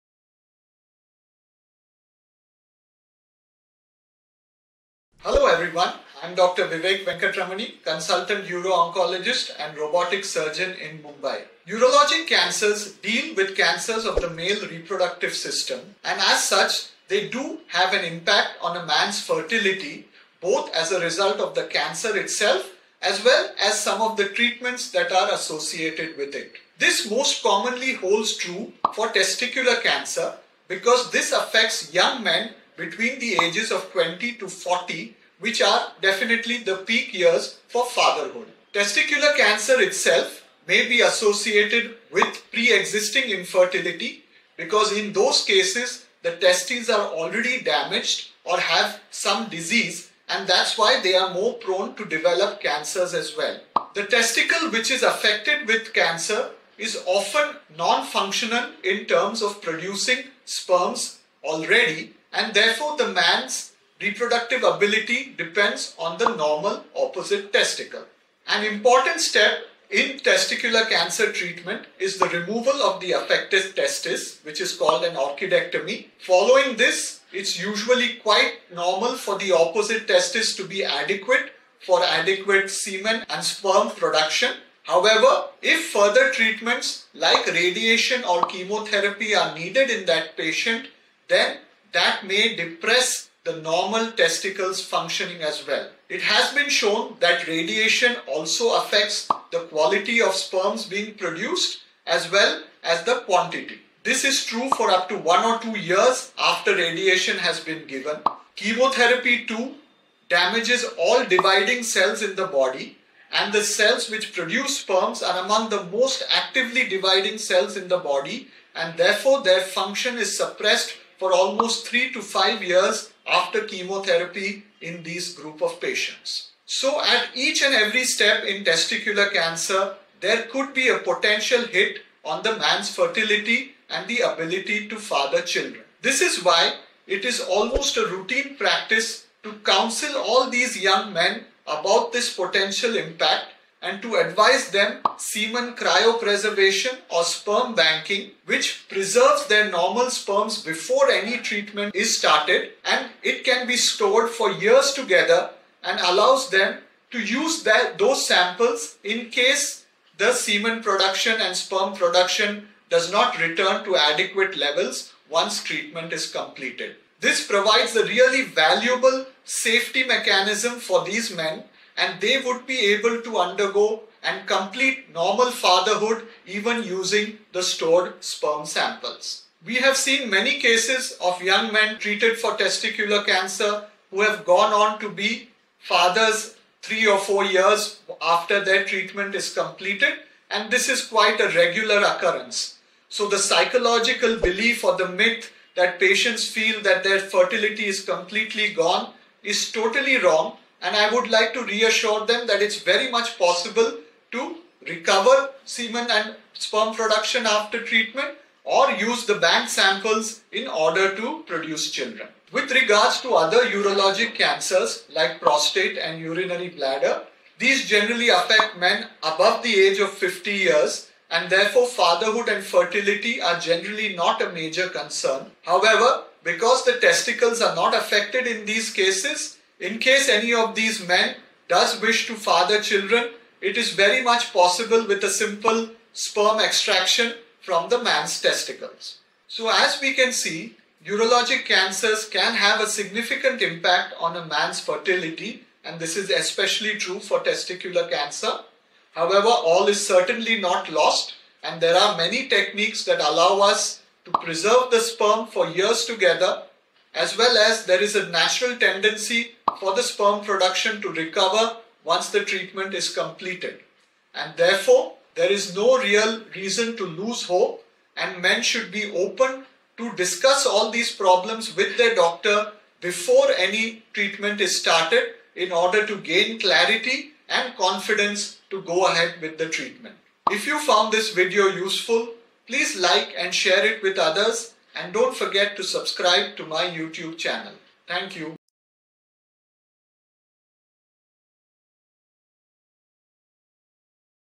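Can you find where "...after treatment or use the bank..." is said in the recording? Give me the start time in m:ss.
3:27.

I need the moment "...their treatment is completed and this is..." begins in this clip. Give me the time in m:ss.
3:08.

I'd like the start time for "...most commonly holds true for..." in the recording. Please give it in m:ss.
0:27.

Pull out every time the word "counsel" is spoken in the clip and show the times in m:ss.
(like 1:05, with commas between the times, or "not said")
2:19.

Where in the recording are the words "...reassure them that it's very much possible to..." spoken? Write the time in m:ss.
3:21.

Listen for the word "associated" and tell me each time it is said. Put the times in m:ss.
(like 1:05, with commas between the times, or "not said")
0:25, 0:41.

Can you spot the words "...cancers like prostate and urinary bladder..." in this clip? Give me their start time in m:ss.
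3:34.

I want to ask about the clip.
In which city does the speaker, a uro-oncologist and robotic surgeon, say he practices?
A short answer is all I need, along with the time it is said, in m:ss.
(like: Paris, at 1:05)
Mumbai, at 0:10.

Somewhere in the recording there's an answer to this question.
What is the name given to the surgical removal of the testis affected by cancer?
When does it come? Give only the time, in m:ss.
1:15.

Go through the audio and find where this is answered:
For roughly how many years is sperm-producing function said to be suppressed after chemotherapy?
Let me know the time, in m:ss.
2:01.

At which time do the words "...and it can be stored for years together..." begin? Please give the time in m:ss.
2:32.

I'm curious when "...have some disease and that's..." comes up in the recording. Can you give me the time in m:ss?
0:48.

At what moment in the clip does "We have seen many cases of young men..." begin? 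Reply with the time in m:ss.
2:59.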